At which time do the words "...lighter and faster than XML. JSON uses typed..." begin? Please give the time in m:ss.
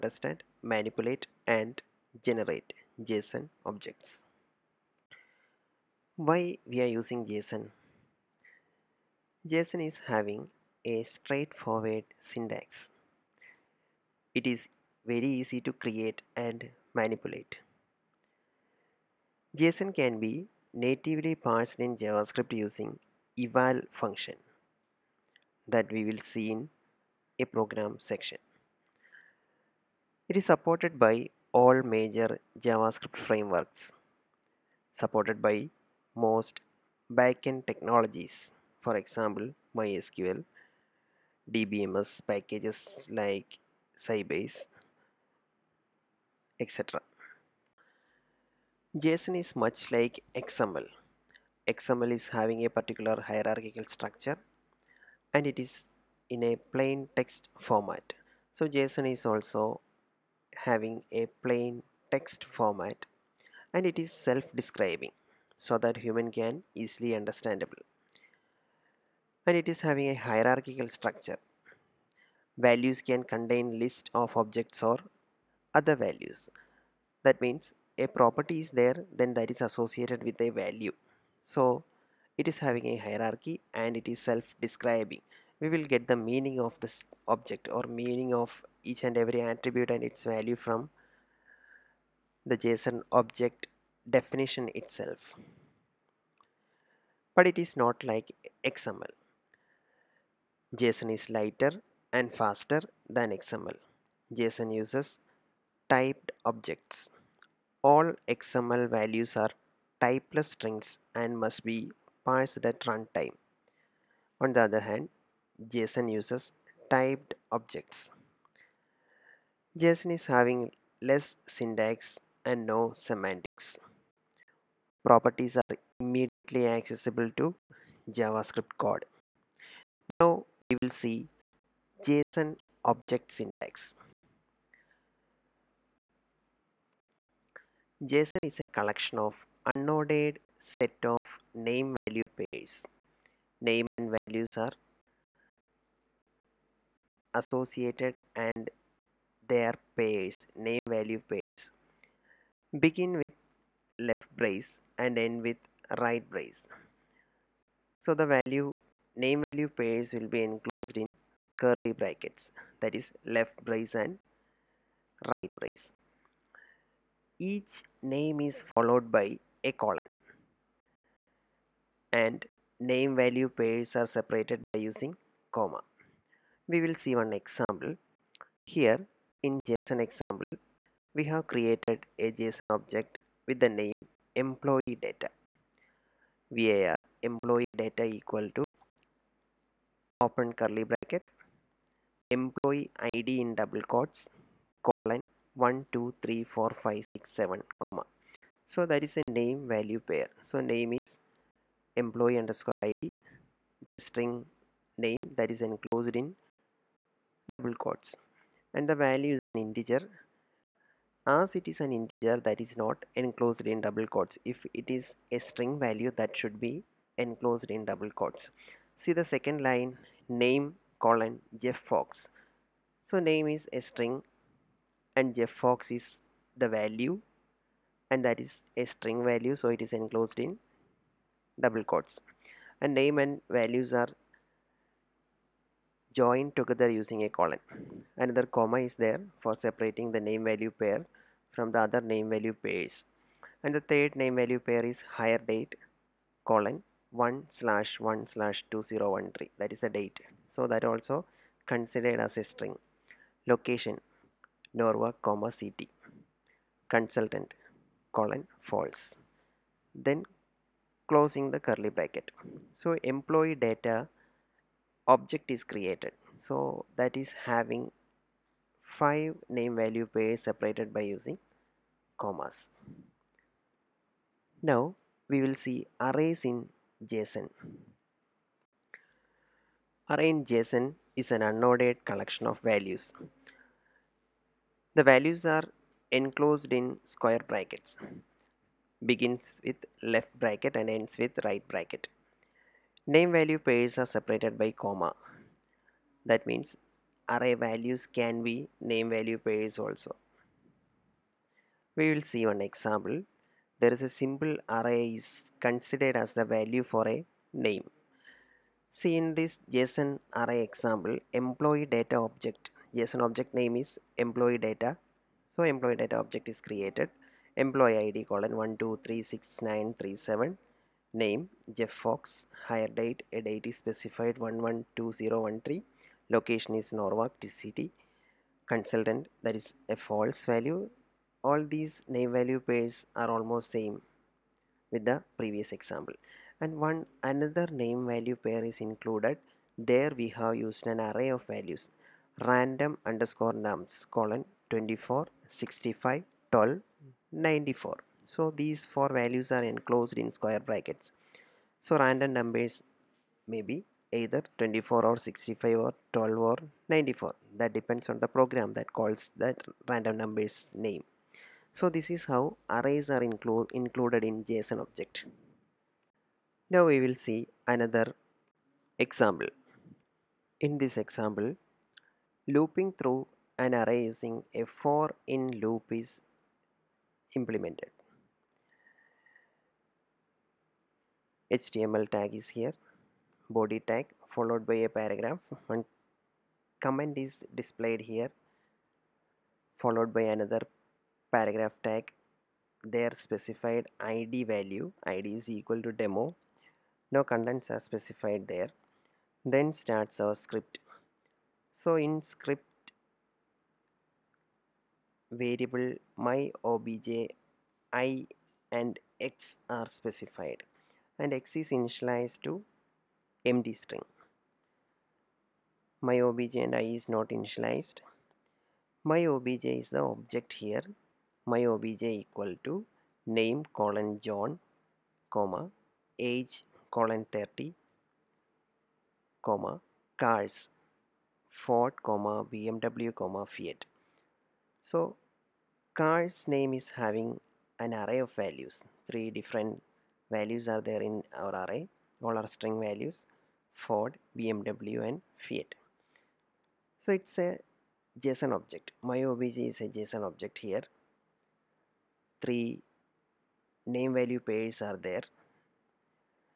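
1:41.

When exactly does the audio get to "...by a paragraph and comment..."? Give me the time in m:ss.
6:24.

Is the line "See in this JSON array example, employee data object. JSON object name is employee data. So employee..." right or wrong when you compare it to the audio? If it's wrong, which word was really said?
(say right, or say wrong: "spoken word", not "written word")
right.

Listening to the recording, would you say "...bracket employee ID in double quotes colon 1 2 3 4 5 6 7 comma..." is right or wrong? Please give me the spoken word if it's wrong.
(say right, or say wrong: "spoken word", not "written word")
right.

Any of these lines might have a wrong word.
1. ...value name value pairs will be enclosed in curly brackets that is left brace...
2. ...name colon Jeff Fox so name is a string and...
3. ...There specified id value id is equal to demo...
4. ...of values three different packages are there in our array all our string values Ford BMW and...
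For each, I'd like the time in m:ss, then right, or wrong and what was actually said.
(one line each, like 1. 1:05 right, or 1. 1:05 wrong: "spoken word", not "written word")
1. 2:38 right
2. 3:40 right
3. 6:32 right
4. 7:18 wrong: "values", not "packages".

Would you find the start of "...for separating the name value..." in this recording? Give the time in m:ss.
3:59.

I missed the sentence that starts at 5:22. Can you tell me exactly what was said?
Hire date a date is specified 112013.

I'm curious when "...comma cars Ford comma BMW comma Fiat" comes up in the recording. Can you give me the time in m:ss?
7:09.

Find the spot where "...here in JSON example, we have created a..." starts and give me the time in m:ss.
2:58.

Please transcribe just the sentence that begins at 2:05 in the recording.
Properties are immediately accessible to JavaScript code.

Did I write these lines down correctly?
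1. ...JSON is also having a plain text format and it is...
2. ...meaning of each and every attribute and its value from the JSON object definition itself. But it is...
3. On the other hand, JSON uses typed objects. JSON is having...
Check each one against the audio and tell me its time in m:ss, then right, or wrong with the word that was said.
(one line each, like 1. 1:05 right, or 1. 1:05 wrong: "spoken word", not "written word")
1. 0:58 right
2. 1:28 right
3. 1:54 right.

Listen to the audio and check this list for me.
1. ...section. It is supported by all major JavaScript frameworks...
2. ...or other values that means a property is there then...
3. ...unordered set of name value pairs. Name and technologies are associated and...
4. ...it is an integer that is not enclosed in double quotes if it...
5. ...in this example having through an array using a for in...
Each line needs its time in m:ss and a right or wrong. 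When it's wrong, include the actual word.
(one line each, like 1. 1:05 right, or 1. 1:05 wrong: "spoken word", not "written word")
1. 0:27 right
2. 1:14 right
3. 2:19 wrong: "values", not "technologies"
4. 3:31 right
5. 6:10 wrong: "looping", not "having".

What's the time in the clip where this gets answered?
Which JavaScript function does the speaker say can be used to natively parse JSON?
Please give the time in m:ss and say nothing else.
0:23.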